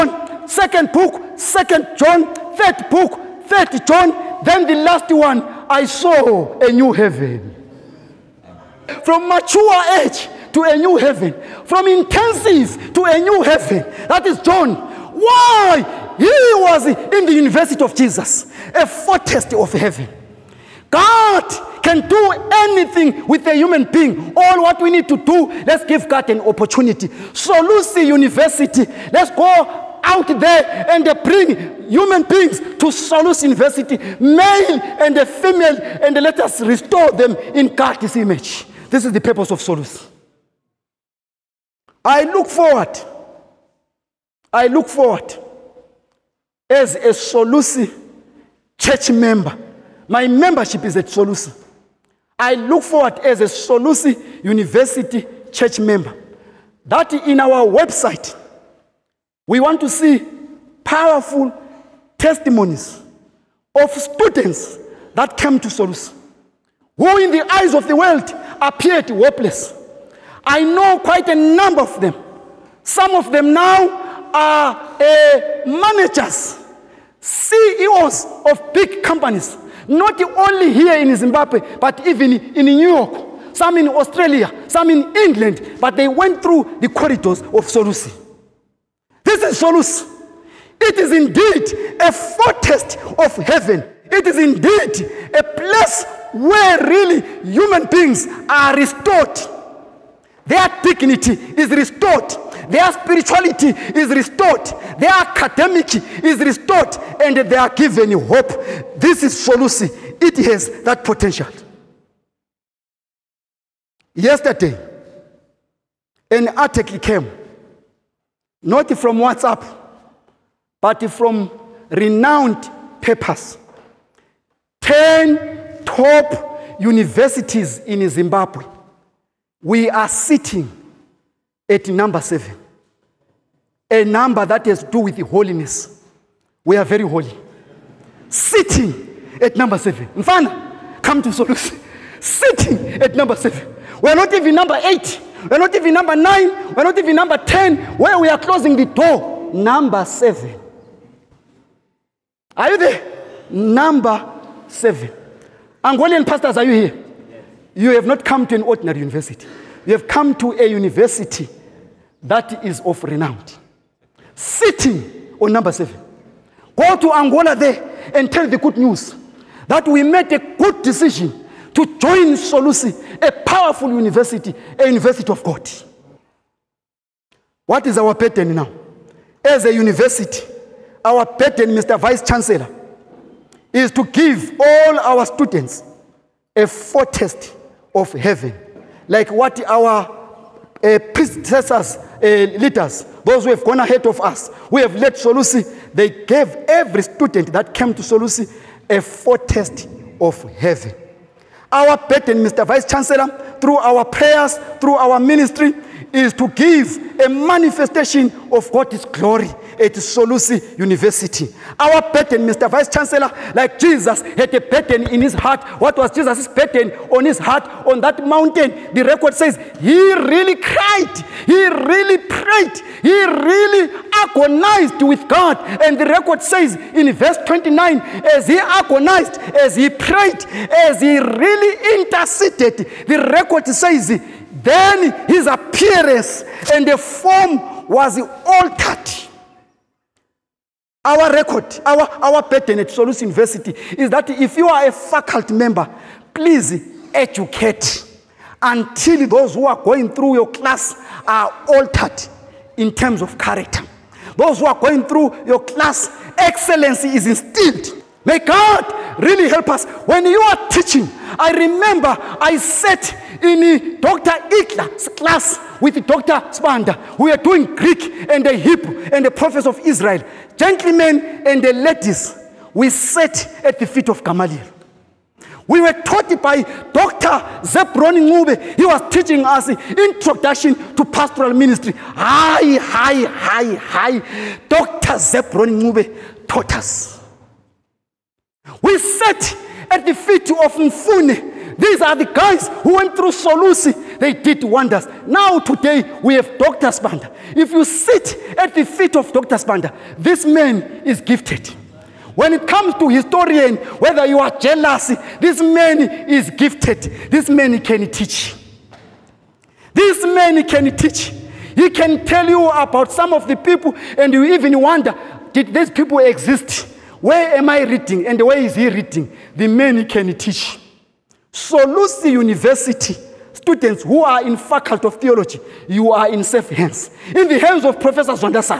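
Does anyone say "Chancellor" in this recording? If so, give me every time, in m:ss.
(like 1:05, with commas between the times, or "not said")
3:02, 3:22, 3:32.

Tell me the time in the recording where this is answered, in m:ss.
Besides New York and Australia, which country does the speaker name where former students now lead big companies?
1:25.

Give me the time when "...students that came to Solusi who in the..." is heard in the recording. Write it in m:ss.
1:03.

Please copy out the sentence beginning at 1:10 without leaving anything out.
I know quite a number of them.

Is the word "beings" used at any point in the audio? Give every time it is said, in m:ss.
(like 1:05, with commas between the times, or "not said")
0:23, 0:32, 1:37.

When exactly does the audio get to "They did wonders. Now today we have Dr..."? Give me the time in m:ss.
4:54.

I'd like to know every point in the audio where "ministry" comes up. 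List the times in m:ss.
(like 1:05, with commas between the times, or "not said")
3:25, 4:41.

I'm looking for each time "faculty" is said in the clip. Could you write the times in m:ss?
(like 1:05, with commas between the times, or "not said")
4:04, 5:24.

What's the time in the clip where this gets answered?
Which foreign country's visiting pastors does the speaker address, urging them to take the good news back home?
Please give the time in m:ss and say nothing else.
2:47.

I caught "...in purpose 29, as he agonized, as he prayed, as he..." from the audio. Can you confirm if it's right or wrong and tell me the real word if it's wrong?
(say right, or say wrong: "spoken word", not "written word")
wrong: "verse", not "purpose".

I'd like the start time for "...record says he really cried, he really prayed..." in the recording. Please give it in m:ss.
3:39.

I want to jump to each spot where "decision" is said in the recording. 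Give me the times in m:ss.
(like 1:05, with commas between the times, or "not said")
2:50.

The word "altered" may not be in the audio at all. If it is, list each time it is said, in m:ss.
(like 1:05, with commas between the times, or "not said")
3:58, 4:11.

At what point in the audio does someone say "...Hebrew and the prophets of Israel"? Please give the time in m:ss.
4:28.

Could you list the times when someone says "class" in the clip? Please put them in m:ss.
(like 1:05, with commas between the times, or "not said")
4:10, 4:15, 4:25.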